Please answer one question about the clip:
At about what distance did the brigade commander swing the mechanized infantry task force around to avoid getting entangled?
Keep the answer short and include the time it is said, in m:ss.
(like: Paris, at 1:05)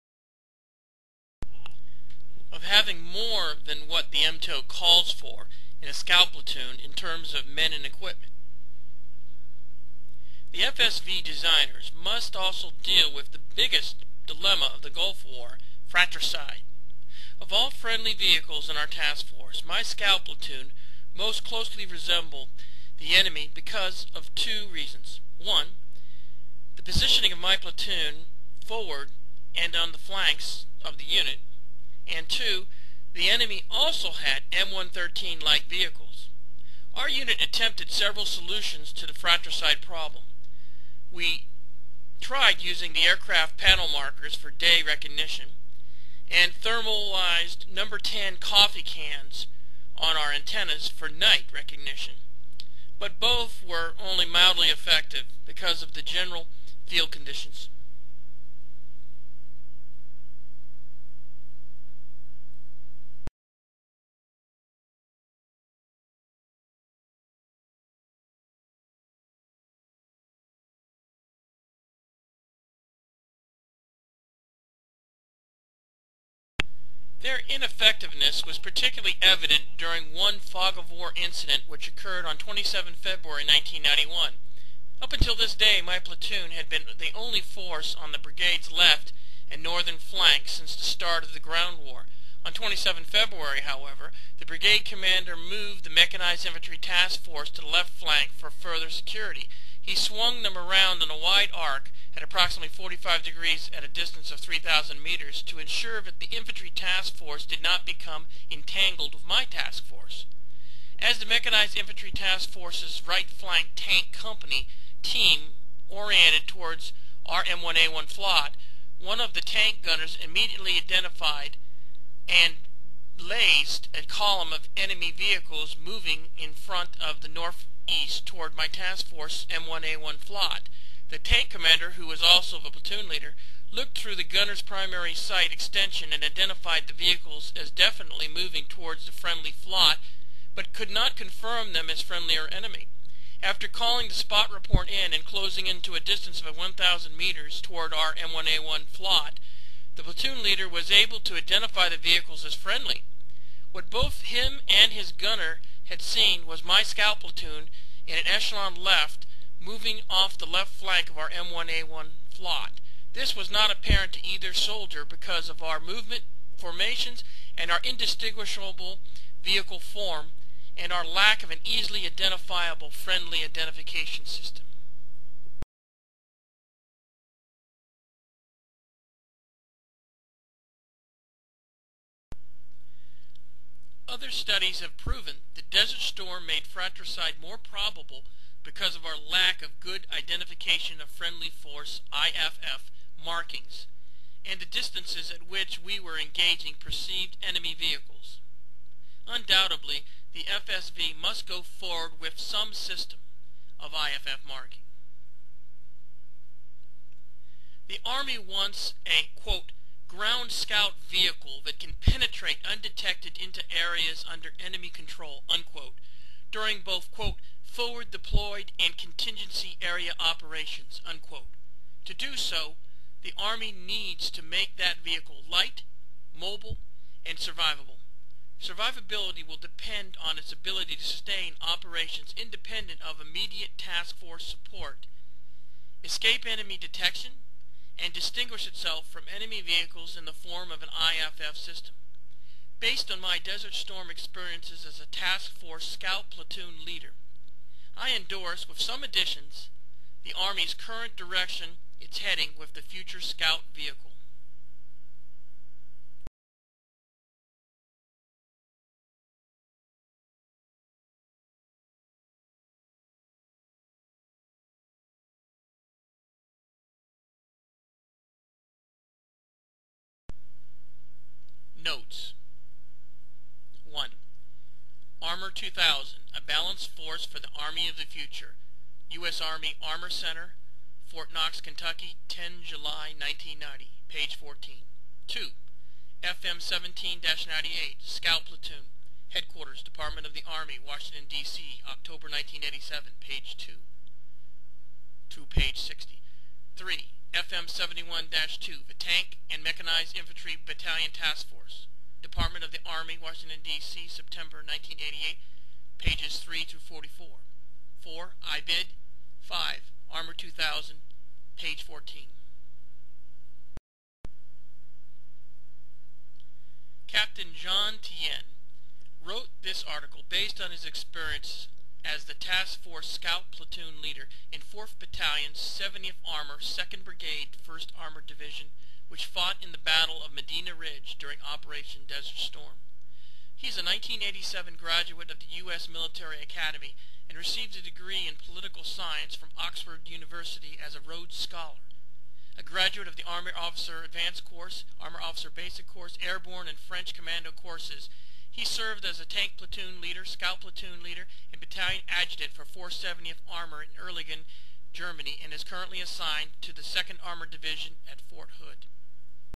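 3,000 meters, at 1:44.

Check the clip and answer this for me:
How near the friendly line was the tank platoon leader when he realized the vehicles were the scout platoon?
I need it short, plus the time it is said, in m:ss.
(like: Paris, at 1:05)
1,000 meters, at 2:26.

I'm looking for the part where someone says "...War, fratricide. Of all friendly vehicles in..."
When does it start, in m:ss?
0:15.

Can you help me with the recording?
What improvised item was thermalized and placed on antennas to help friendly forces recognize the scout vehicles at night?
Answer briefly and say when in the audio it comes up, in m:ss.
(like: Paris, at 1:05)
number 10 coffee cans, at 0:47.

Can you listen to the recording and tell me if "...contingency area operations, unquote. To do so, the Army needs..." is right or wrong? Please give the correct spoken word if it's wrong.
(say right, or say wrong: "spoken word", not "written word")
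right.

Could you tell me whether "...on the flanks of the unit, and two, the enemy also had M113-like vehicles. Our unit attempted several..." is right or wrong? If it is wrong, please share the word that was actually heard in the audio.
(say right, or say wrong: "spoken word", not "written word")
right.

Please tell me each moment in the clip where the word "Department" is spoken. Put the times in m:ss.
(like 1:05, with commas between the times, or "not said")
4:49, 5:02.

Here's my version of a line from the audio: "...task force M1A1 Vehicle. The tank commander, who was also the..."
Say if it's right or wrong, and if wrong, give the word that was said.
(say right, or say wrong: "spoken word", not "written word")
wrong: "Flot", not "Vehicle".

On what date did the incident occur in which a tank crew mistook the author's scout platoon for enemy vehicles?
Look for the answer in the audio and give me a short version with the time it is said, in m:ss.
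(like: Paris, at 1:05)
27 February 1991, at 1:22.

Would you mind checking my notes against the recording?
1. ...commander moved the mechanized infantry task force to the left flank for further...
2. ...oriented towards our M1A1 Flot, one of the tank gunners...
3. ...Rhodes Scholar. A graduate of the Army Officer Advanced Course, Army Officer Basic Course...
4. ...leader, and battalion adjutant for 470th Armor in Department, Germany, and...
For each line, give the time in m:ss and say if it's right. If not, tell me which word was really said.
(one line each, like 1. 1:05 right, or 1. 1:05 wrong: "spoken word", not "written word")
1. 1:34 right
2. 1:55 right
3. 5:41 right
4. 5:51 wrong: "Erlangen", not "Department".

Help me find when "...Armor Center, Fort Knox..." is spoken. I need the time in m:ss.
4:39.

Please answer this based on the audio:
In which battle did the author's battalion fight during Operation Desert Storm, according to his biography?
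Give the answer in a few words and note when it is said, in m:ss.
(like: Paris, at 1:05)
Battle of Medina Ridge, at 5:29.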